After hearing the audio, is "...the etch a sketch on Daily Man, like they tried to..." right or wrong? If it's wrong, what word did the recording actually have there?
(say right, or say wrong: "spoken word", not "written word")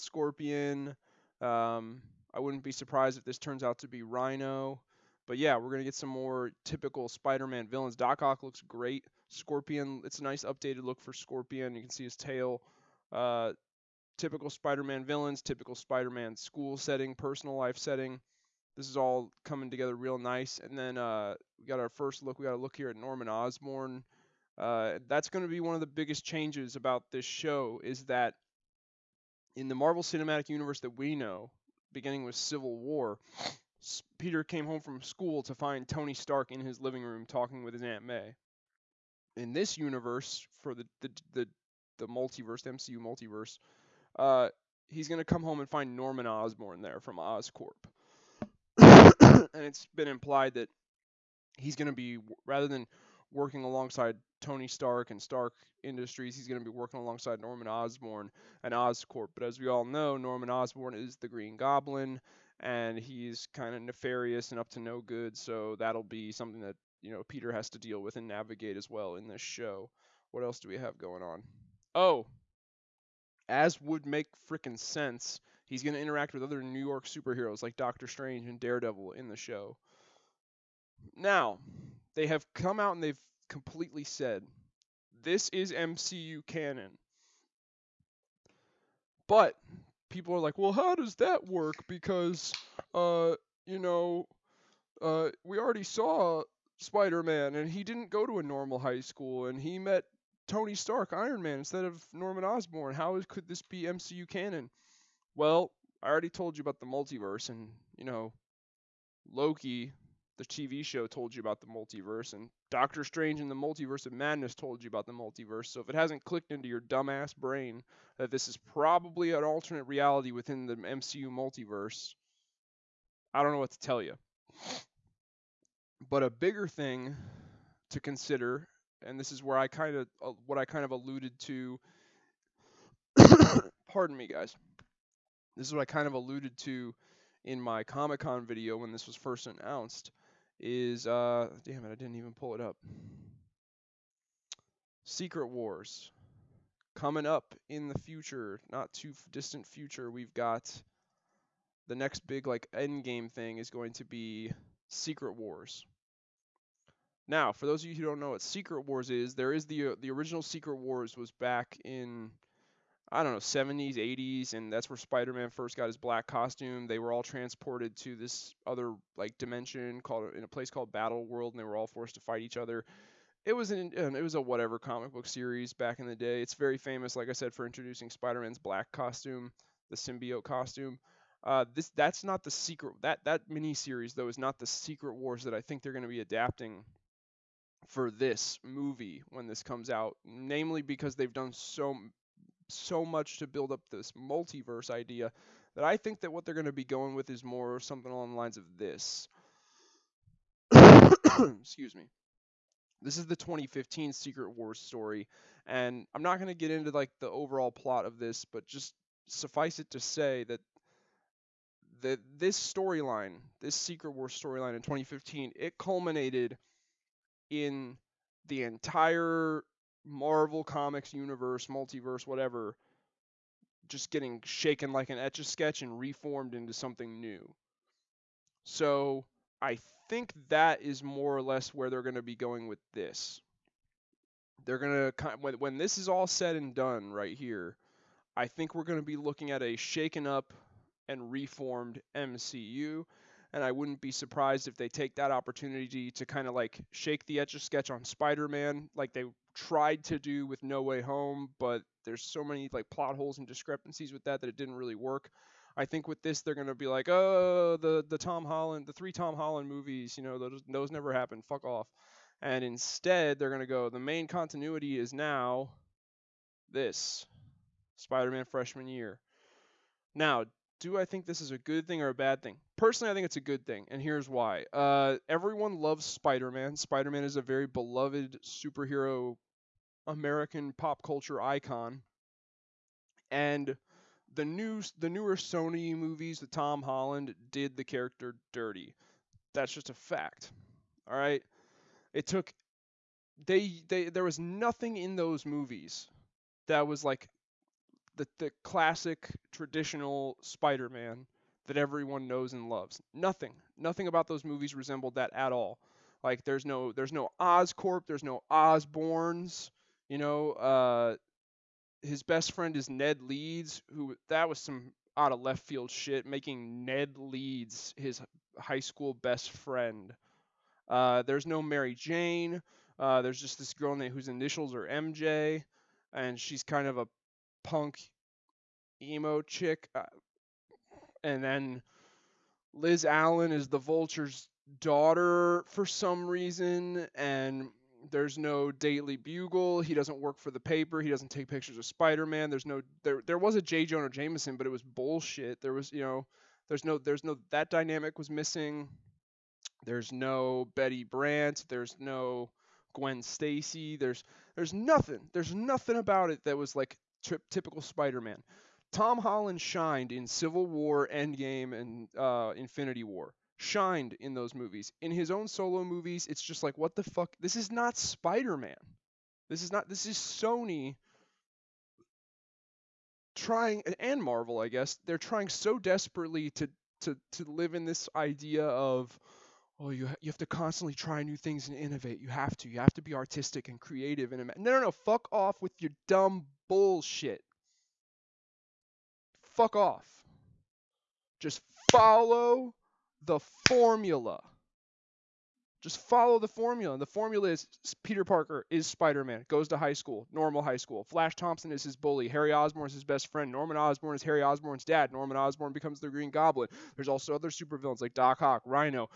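wrong: "Spider", not "Daily".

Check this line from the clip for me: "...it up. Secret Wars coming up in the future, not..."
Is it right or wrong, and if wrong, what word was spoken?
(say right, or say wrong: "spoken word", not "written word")
right.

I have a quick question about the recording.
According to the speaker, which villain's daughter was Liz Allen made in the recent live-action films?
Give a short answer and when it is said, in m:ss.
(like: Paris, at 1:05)
the Vulture, at 5:33.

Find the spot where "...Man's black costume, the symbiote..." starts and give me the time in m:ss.
2:58.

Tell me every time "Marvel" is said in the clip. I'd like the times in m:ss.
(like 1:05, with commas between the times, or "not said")
0:29, 3:40, 6:14.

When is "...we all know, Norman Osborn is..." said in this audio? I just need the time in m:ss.
0:59.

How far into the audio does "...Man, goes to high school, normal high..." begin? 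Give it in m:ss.
6:39.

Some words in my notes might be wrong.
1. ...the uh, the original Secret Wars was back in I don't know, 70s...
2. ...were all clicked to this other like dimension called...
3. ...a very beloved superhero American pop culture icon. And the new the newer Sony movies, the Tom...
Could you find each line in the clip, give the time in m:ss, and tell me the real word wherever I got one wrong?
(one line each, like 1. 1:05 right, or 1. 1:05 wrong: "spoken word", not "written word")
1. 2:39 right
2. 2:46 wrong: "transported", not "clicked"
3. 4:37 right.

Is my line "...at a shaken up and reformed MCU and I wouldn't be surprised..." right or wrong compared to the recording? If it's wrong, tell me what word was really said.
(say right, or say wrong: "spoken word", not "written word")
right.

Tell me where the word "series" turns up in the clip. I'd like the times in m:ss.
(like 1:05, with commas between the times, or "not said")
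2:55, 3:03.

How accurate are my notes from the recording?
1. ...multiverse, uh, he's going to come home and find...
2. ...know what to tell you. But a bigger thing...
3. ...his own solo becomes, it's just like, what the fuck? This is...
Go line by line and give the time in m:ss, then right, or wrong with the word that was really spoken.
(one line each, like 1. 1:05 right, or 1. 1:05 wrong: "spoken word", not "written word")
1. 0:42 right
2. 2:03 right
3. 6:05 wrong: "movies", not "becomes".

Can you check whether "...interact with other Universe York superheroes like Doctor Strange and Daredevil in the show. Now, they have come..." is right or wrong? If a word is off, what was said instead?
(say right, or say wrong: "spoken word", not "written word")
wrong: "New", not "Universe".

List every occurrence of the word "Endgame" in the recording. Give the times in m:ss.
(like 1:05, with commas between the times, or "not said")
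6:01.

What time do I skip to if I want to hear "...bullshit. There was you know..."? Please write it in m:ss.
5:44.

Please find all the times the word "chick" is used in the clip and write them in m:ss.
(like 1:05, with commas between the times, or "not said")
5:29.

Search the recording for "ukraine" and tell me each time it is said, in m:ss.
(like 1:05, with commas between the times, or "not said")
not said.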